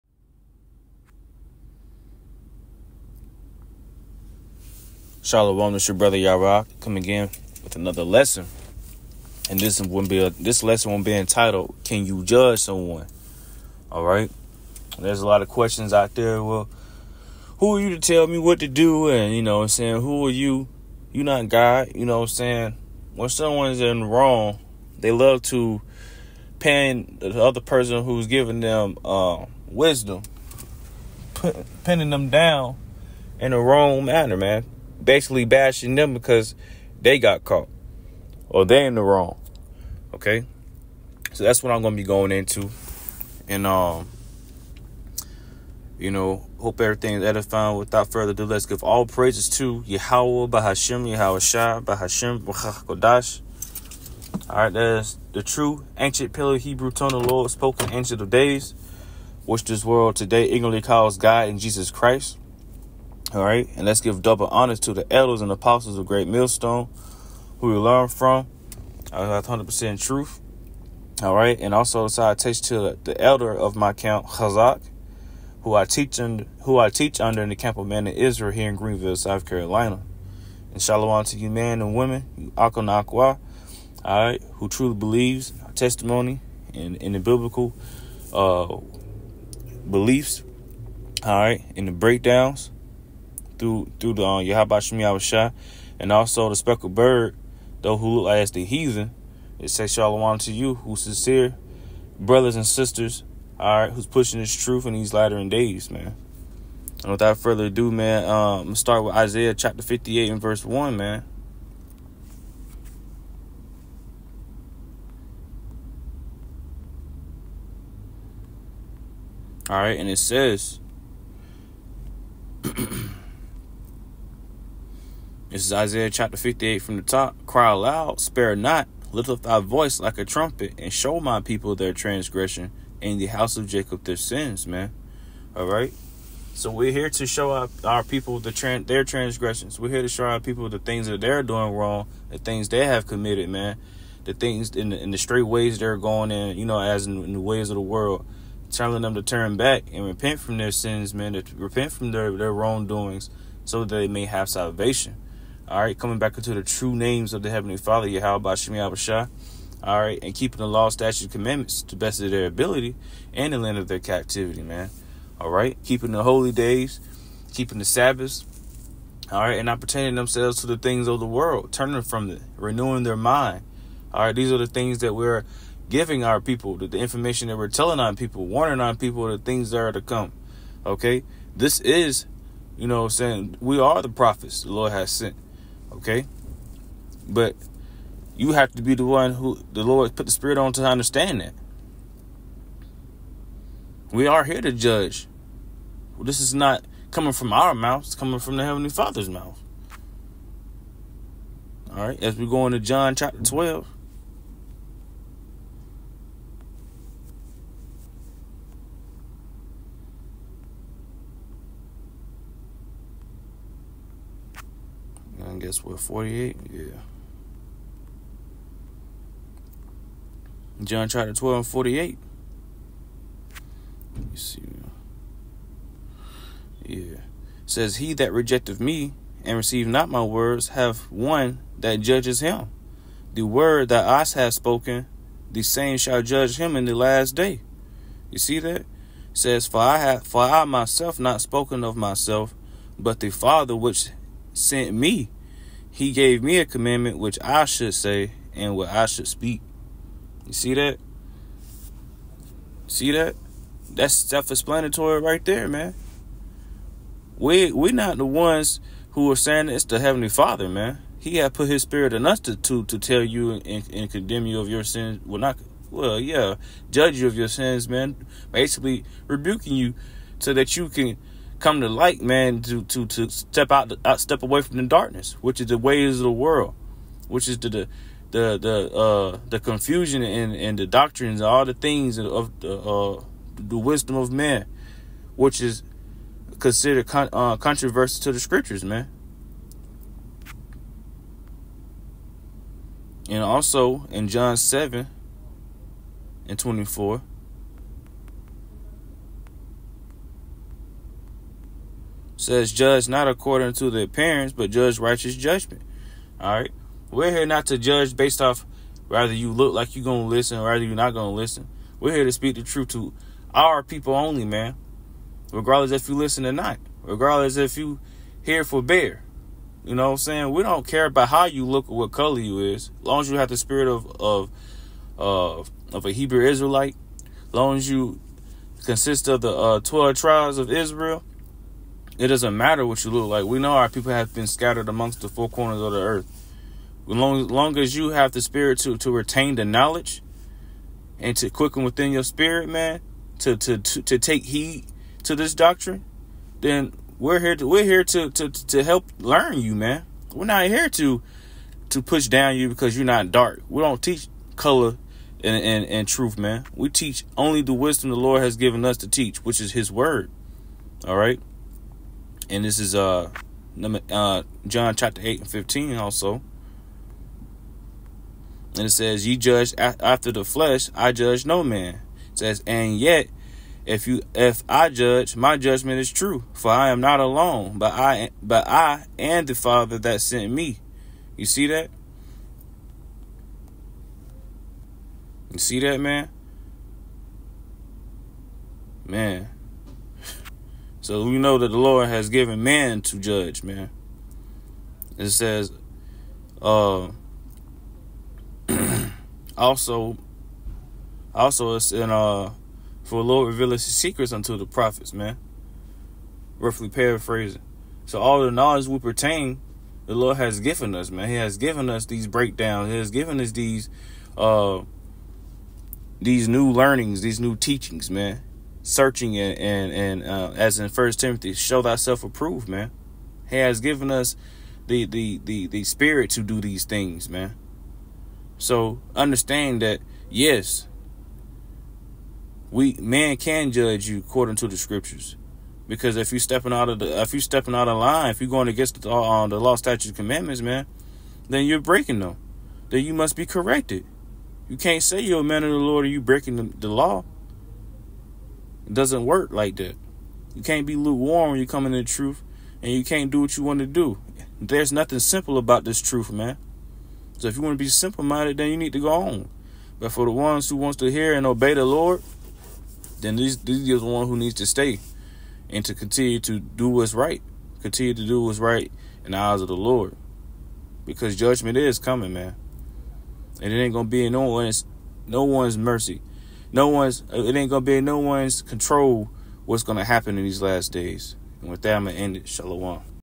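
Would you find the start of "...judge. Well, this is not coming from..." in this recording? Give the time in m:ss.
3:14.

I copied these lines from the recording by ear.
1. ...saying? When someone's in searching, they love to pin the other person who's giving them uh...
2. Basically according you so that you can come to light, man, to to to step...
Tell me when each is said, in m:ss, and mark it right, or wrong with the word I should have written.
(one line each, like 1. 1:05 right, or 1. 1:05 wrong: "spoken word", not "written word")
1. 0:22 wrong: "wrong", not "searching"
2. 4:28 wrong: "rebuking", not "according".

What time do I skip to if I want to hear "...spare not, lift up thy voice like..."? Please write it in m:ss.
2:08.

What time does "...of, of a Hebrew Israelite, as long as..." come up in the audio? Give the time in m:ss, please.
5:25.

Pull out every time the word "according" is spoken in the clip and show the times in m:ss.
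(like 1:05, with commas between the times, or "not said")
5:03, 7:14.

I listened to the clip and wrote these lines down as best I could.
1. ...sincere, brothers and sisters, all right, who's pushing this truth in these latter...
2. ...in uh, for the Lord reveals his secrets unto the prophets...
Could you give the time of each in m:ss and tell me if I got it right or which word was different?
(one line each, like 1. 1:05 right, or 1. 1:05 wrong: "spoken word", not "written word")
1. 1:41 right
2. 6:41 right.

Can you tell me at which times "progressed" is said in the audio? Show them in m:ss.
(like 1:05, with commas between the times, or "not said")
not said.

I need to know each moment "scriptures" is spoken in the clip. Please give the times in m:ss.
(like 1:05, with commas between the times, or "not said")
4:48, 7:14.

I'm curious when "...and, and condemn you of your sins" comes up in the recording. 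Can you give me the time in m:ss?
4:23.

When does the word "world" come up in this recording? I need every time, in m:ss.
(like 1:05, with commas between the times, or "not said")
0:59, 2:27, 2:51, 4:36.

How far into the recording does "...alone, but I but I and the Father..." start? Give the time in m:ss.
6:17.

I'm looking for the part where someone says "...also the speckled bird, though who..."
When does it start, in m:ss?
1:36.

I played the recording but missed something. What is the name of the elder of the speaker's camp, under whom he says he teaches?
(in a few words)
Chazak.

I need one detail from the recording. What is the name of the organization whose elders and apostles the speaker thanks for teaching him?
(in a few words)
Great Millstone.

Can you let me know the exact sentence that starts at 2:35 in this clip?
All right, coming back into the true names of the Heavenly Father, Yahweh Shemi Abashah.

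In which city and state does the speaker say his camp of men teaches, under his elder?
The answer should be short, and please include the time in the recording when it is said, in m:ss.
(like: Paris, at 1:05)
Greenville, South Carolina, at 1:18.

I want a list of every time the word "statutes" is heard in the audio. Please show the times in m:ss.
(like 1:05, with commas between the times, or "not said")
2:40, 7:19.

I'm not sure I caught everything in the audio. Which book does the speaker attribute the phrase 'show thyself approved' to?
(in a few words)
First Timothy.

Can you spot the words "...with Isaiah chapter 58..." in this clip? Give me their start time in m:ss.
1:49.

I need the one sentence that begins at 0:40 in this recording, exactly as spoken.
Okay, so that's what I'm gonna be going into, and um, you know, hope everything is edifying.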